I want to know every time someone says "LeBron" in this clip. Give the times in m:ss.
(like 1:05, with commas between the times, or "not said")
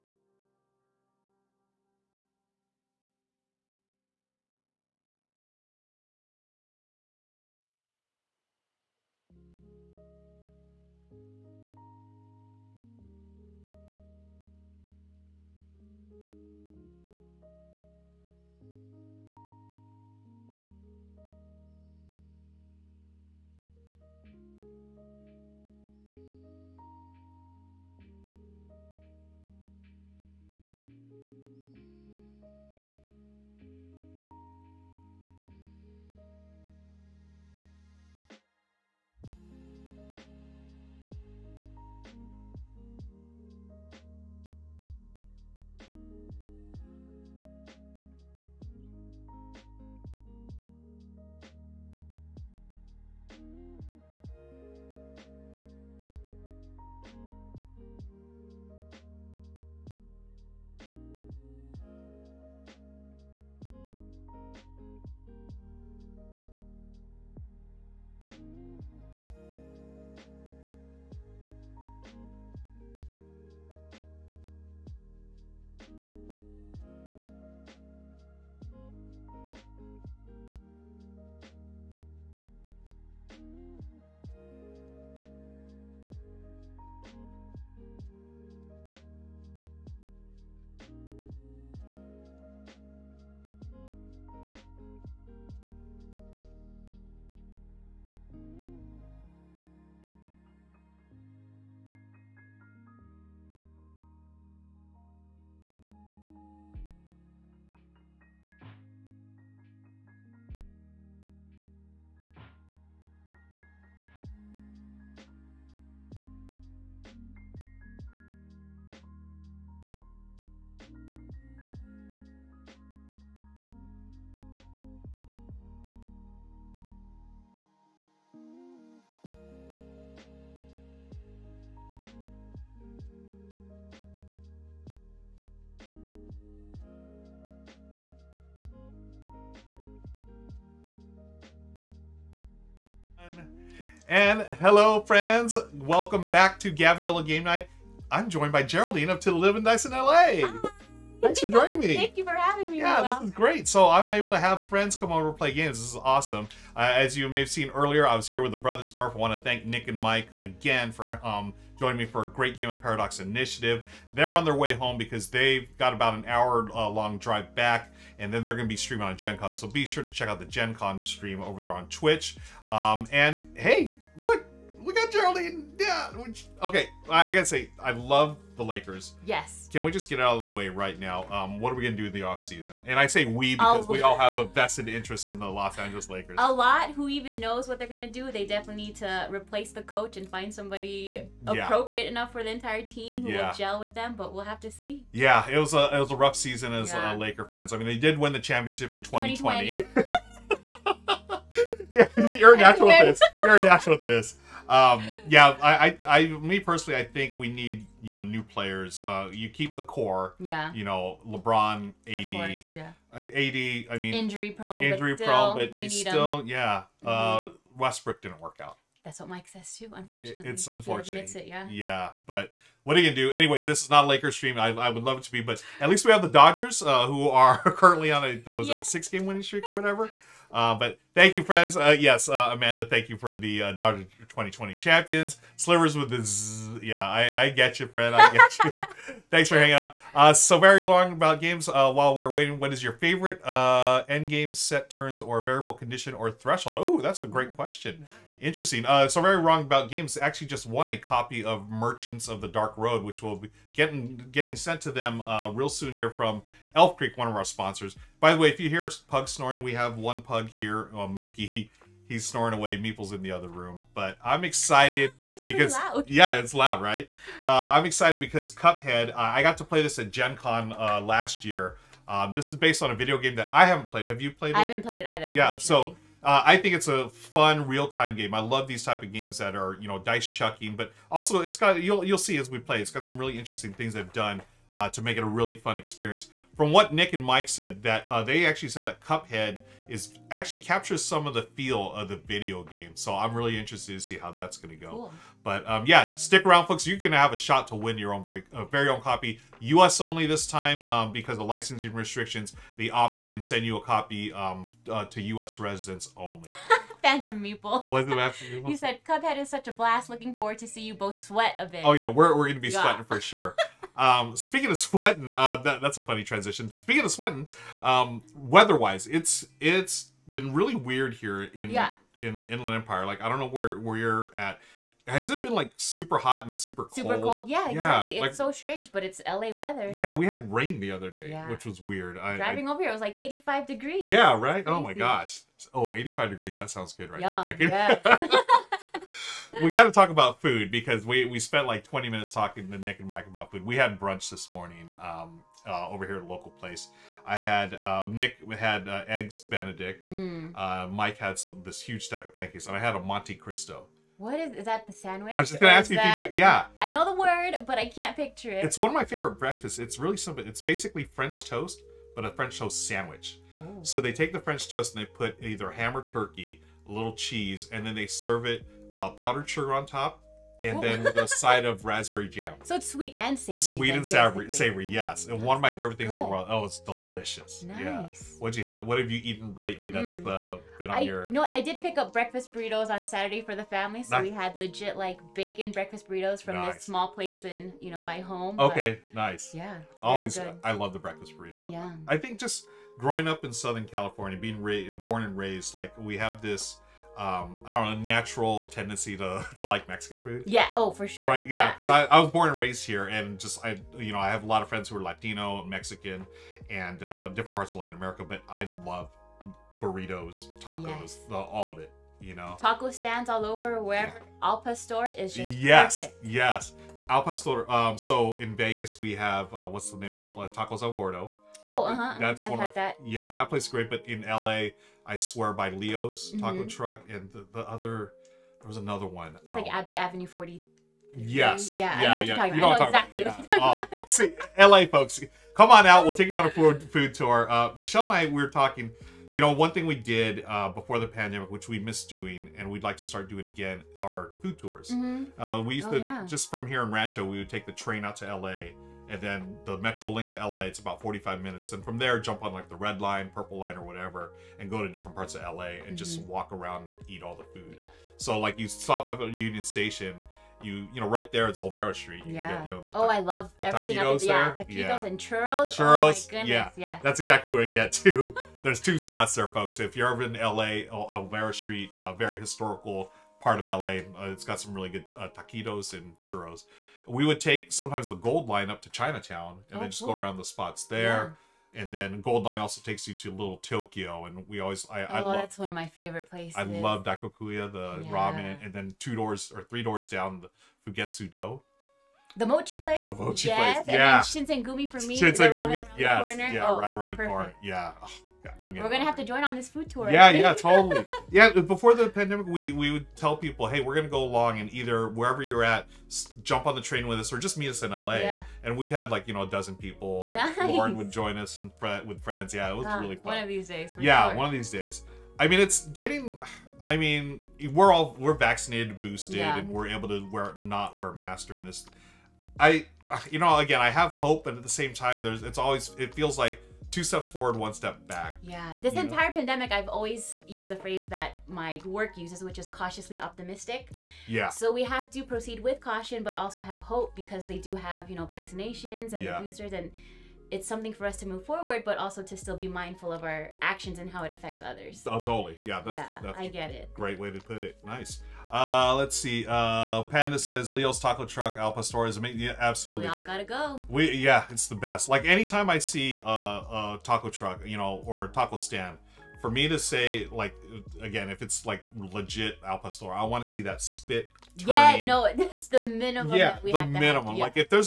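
3:31.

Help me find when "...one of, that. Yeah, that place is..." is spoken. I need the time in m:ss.
7:02.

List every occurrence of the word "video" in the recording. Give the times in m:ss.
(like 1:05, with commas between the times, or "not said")
4:32, 4:52.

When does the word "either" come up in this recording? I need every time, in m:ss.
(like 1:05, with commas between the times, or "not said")
4:35, 6:05, 8:24.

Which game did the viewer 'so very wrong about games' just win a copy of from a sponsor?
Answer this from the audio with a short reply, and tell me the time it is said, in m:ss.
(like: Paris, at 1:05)
Merchants of the Dark Road, at 4:11.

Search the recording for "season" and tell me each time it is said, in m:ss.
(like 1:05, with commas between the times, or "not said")
3:02, 3:16.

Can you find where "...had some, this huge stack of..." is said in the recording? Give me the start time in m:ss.
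5:51.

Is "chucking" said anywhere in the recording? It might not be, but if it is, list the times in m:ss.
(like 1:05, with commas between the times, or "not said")
4:40.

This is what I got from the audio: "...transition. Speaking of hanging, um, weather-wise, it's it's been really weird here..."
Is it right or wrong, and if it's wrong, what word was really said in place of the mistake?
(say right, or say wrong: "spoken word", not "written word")
wrong: "sweating", not "hanging".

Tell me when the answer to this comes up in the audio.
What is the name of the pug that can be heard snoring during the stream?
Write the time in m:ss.
4:21.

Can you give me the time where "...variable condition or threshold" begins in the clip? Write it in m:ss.
4:05.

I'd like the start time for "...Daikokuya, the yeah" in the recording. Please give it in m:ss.
8:07.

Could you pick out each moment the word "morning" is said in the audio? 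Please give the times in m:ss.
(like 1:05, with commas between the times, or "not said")
5:44.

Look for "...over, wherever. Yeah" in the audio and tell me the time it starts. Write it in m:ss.
6:53.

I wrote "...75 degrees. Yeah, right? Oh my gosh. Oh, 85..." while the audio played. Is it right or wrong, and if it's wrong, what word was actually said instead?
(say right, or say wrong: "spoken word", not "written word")
wrong: "85", not "75".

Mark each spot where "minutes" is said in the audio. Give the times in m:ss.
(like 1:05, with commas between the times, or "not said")
5:42, 7:31.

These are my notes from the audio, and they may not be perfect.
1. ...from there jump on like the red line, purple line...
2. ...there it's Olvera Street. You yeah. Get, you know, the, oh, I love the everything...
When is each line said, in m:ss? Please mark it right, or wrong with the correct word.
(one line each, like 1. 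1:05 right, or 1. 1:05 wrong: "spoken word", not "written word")
1. 7:31 right
2. 7:41 right.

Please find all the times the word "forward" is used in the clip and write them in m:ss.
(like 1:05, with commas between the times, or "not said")
5:10, 8:47, 9:01.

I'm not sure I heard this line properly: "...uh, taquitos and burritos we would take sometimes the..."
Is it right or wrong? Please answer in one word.
wrong.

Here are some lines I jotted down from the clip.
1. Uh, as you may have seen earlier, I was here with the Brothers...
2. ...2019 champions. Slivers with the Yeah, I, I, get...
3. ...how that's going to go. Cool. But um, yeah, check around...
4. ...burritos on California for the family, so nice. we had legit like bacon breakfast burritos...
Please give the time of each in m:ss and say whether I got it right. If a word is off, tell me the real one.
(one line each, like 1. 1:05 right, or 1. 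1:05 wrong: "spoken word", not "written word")
1. 2:36 right
2. 3:54 wrong: "2020", not "2019"
3. 4:54 wrong: "stick", not "check"
4. 6:22 wrong: "Saturday", not "California".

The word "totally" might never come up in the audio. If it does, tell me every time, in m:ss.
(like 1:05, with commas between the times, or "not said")
8:20, 9:05.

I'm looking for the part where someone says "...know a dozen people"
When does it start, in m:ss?
8:29.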